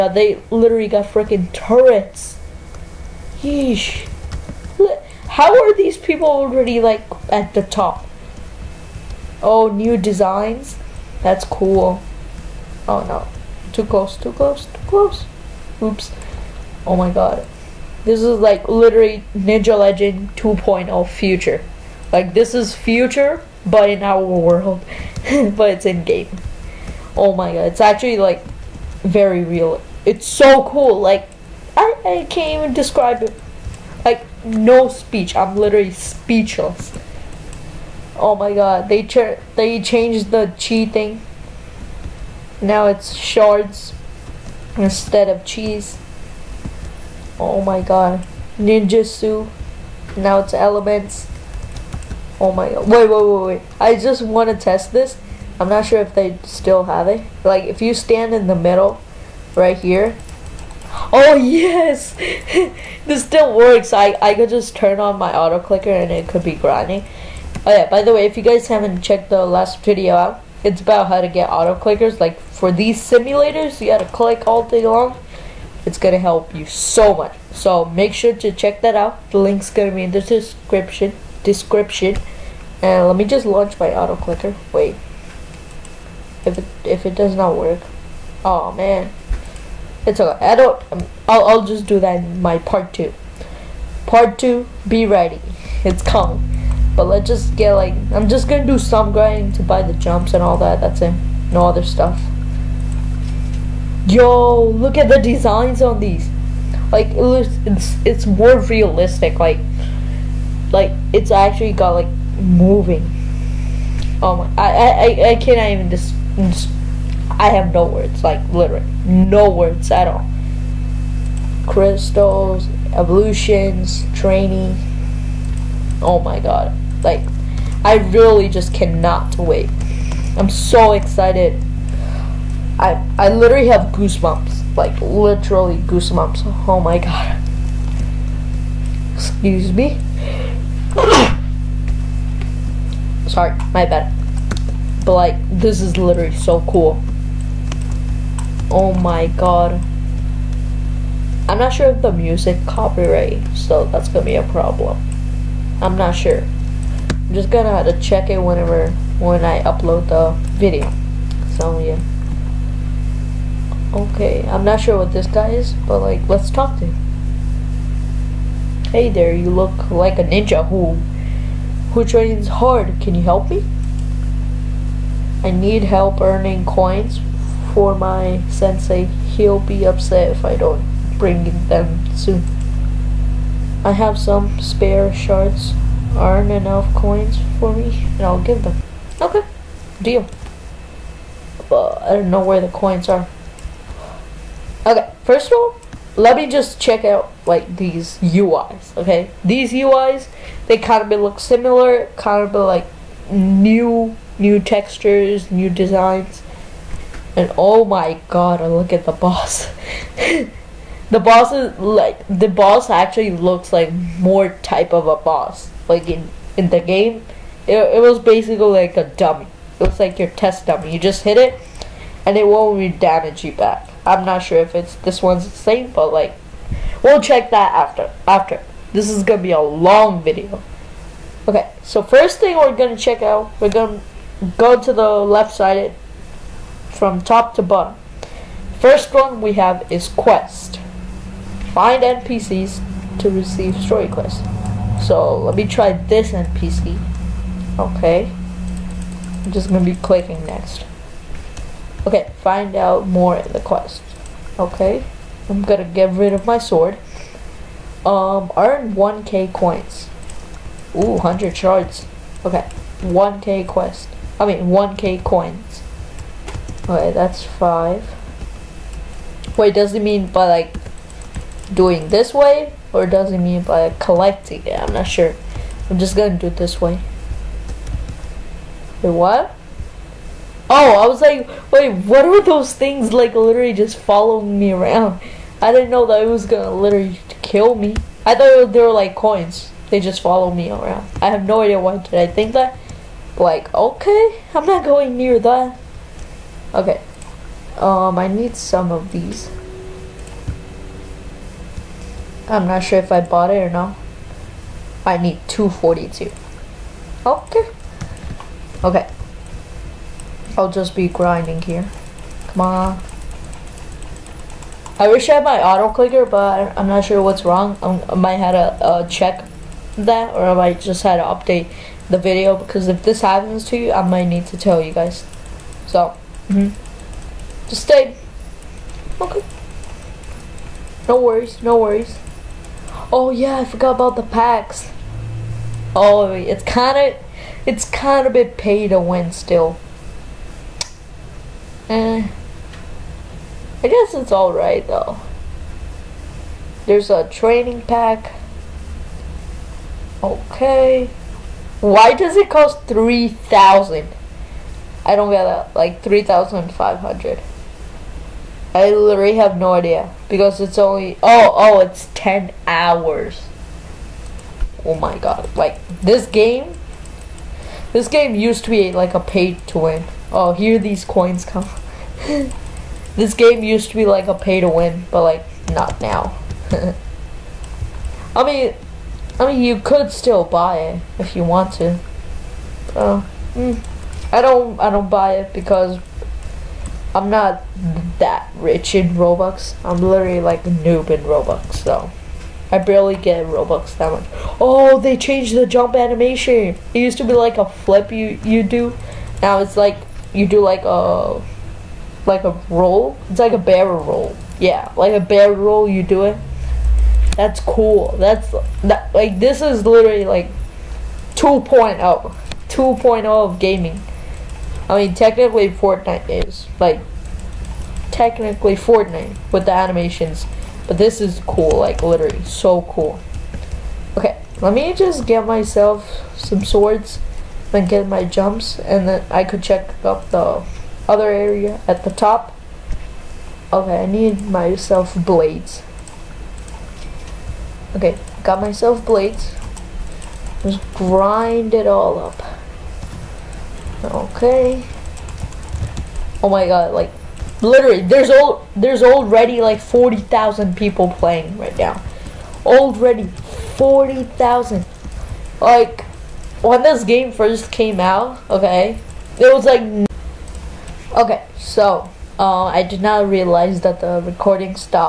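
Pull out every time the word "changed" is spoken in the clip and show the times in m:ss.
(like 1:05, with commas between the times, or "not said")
0:39, 6:35.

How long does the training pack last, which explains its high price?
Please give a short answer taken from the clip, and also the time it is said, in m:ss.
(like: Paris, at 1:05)
10 hours, at 6:02.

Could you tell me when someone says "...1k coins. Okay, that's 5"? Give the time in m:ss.
4:24.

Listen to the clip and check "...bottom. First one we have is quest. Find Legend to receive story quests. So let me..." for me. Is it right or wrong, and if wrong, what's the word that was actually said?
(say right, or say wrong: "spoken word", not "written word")
wrong: "NPCs", not "Legend".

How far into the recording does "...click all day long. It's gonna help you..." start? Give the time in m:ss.
1:14.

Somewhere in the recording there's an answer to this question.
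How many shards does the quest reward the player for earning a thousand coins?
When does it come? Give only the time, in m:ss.
4:21.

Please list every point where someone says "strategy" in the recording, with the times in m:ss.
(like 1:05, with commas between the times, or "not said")
not said.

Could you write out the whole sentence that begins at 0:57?
Like, if you stand in the middle, right here.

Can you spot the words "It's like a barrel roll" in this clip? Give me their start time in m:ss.
6:43.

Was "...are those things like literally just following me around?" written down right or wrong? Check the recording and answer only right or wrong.
right.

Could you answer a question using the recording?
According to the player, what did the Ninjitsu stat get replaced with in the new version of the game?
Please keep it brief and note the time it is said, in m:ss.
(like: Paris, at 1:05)
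Elements, at 0:50.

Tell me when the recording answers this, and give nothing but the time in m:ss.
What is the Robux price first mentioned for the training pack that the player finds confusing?
5:52.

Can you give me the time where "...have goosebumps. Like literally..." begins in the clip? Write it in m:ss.
2:13.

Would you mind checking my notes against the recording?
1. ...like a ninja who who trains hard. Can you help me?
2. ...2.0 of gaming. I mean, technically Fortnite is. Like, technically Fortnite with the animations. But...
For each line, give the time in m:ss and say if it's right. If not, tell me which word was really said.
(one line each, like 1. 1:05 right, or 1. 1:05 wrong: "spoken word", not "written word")
1. 2:49 right
2. 6:51 right.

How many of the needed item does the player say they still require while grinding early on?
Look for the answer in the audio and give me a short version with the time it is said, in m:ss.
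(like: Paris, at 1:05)
242, at 5:05.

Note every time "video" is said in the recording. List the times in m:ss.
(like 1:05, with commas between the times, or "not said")
1:09, 2:40, 3:50, 5:22.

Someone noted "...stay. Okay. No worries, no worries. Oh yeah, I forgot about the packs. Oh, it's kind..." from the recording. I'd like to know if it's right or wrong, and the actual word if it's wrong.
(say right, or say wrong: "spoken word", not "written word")
right.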